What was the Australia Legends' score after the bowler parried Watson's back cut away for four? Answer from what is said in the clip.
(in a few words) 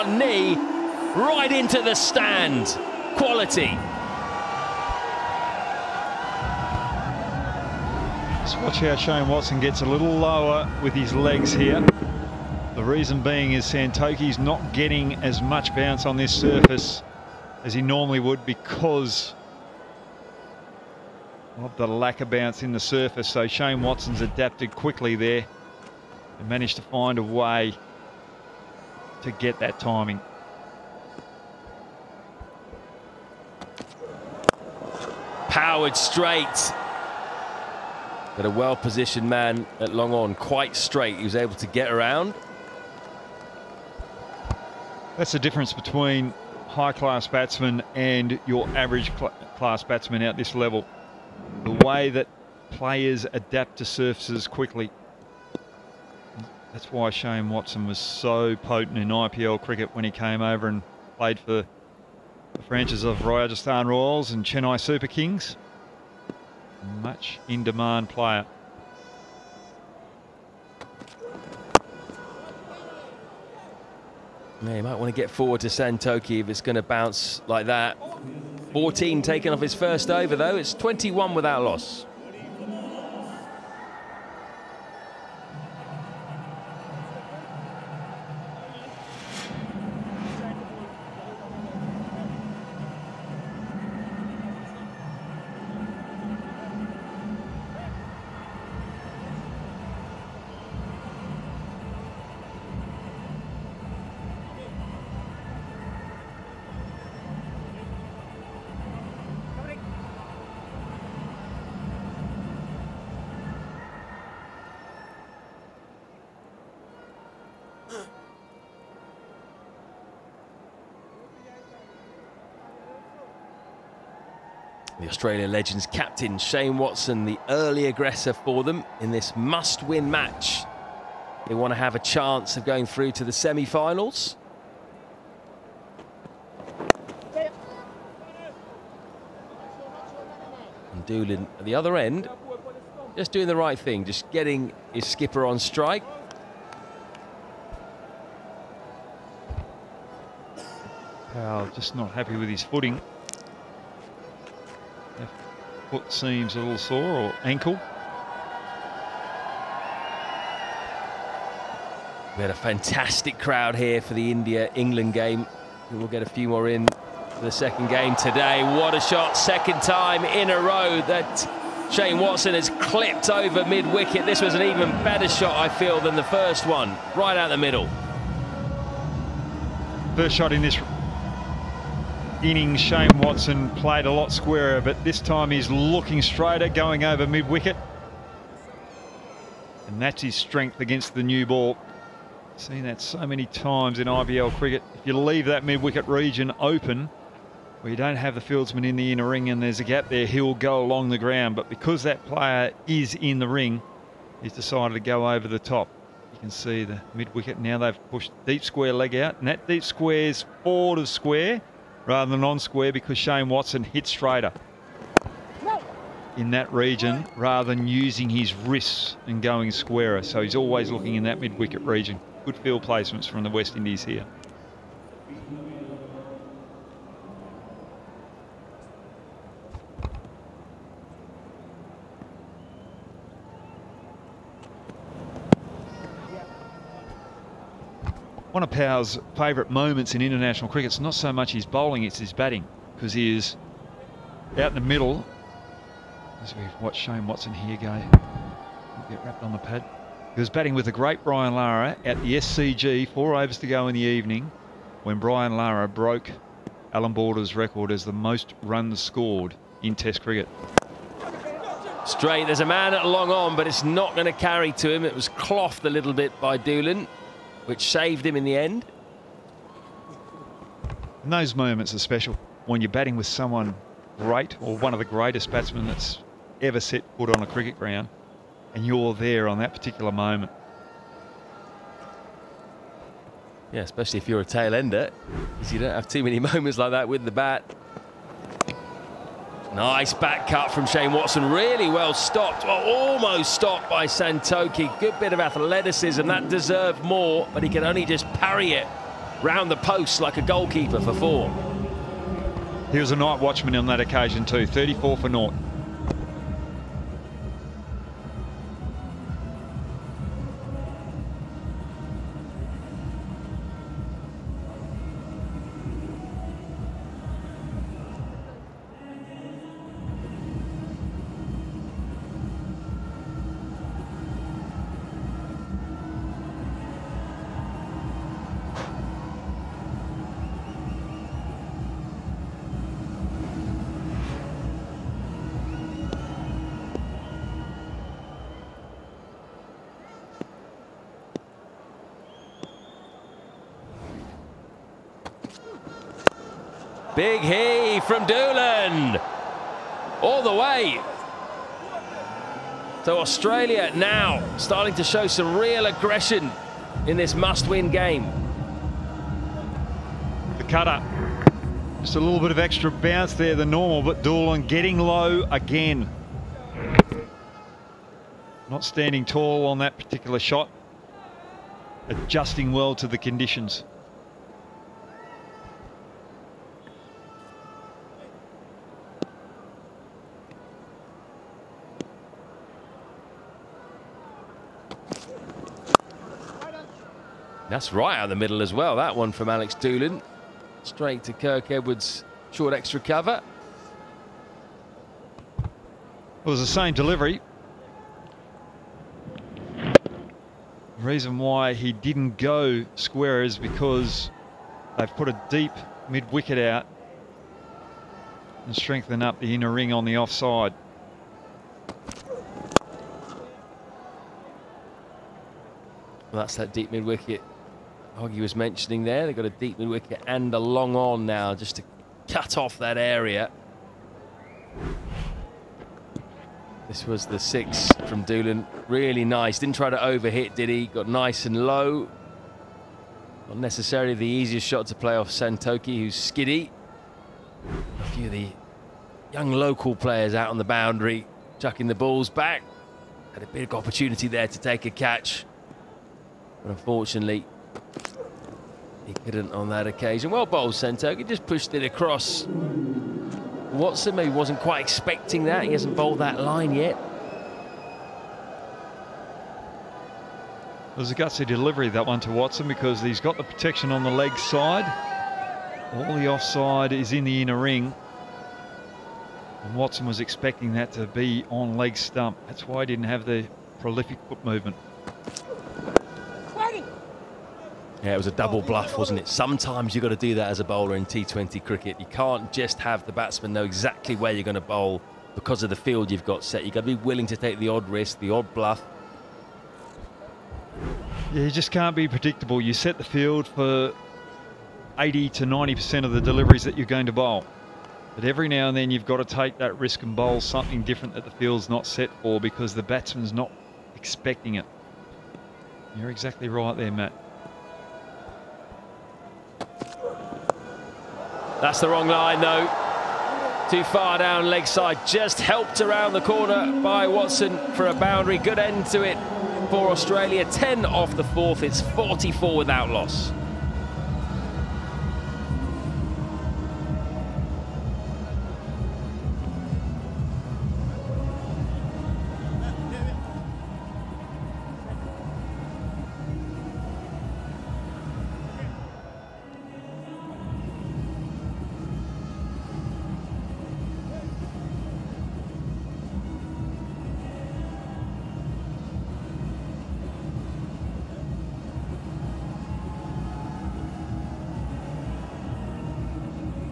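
34 for 0.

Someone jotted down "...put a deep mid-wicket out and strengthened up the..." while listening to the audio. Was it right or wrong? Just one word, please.
right.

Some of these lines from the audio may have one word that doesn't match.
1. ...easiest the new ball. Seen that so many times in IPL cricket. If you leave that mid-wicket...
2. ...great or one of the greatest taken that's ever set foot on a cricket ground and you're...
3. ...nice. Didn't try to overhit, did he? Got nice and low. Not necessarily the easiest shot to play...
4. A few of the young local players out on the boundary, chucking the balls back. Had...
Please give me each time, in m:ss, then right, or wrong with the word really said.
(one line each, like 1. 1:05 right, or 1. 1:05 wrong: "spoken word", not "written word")
1. 3:10 wrong: "against", not "easiest"
2. 4:34 wrong: "batsmen", not "taken"
3. 7:09 right
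4. 7:18 right.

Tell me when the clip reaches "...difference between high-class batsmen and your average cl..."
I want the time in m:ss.
0:45.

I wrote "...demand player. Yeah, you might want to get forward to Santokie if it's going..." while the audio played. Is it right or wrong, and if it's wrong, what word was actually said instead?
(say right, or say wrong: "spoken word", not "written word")
right.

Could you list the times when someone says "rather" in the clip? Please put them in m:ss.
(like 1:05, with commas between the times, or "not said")
3:32, 3:37.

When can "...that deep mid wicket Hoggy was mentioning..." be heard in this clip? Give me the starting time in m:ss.
6:56.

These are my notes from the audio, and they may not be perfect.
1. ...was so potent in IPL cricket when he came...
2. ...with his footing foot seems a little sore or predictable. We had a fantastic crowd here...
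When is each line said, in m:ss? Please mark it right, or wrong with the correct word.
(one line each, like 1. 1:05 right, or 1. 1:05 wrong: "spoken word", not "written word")
1. 0:57 right
2. 2:32 wrong: "ankle", not "predictable".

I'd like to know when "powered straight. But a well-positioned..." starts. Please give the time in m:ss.
0:35.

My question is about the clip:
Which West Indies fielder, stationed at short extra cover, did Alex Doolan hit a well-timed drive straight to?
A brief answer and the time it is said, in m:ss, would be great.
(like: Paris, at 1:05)
Kirk Edwards, at 6:31.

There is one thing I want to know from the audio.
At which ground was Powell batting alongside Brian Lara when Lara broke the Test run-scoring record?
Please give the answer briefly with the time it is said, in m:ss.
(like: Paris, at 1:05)
SCG, at 4:12.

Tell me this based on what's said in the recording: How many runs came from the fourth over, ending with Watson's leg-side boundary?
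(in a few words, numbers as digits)
10.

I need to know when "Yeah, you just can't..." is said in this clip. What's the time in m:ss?
8:11.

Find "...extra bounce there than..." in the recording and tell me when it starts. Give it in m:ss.
6:02.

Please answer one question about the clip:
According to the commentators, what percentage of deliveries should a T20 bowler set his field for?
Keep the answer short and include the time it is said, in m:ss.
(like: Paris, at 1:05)
80 to 90%, at 8:14.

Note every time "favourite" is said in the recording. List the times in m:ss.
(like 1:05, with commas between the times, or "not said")
3:59.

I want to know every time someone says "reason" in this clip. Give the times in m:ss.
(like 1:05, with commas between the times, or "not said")
0:12, 6:40.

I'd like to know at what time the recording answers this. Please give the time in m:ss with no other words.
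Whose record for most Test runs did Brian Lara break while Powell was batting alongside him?
4:16.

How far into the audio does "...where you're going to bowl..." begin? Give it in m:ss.
8:04.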